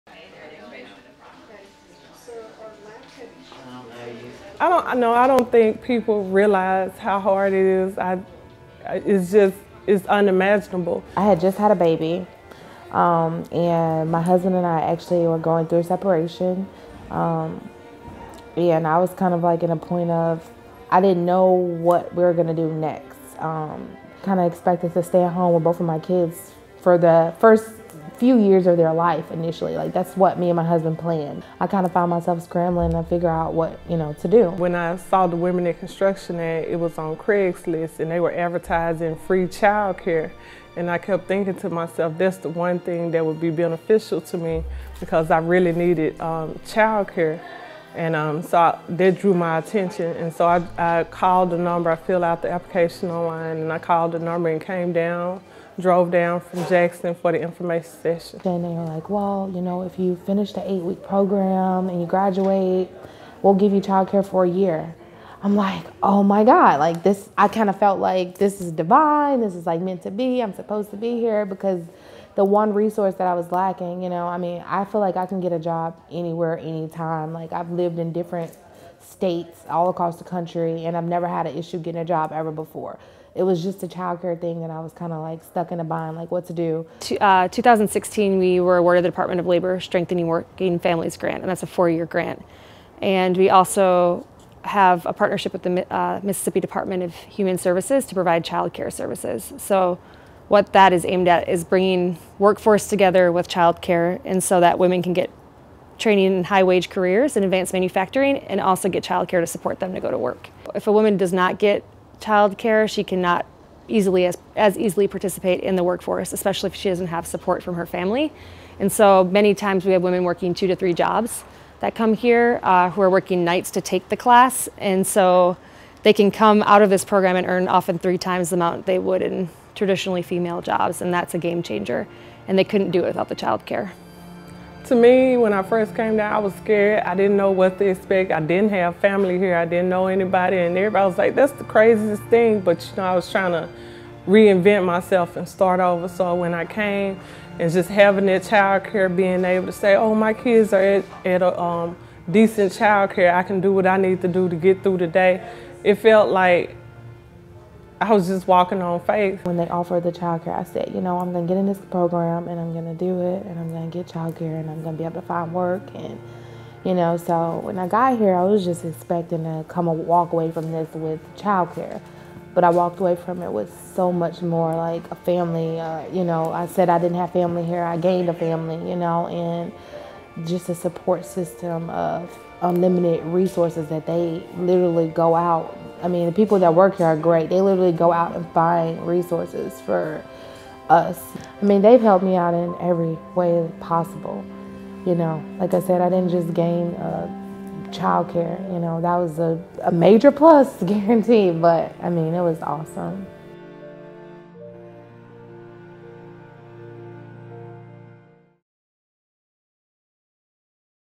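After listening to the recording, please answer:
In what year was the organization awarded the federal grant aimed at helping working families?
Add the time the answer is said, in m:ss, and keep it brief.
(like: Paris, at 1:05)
2016, at 1:27.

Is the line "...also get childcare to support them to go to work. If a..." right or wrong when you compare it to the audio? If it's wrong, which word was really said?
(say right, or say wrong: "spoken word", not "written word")
right.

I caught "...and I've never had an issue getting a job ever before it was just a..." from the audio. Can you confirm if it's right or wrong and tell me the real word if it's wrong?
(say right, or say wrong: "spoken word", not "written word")
right.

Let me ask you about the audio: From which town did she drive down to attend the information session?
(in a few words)
Jackson.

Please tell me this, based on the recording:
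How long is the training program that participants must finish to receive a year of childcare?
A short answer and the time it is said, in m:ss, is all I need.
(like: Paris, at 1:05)
8 weeks, at 1:00.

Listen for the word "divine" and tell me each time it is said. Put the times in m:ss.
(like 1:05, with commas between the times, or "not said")
1:08.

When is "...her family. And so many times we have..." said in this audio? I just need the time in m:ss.
1:57.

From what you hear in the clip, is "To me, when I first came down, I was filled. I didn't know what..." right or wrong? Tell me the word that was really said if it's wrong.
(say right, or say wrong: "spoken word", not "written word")
wrong: "scared", not "filled".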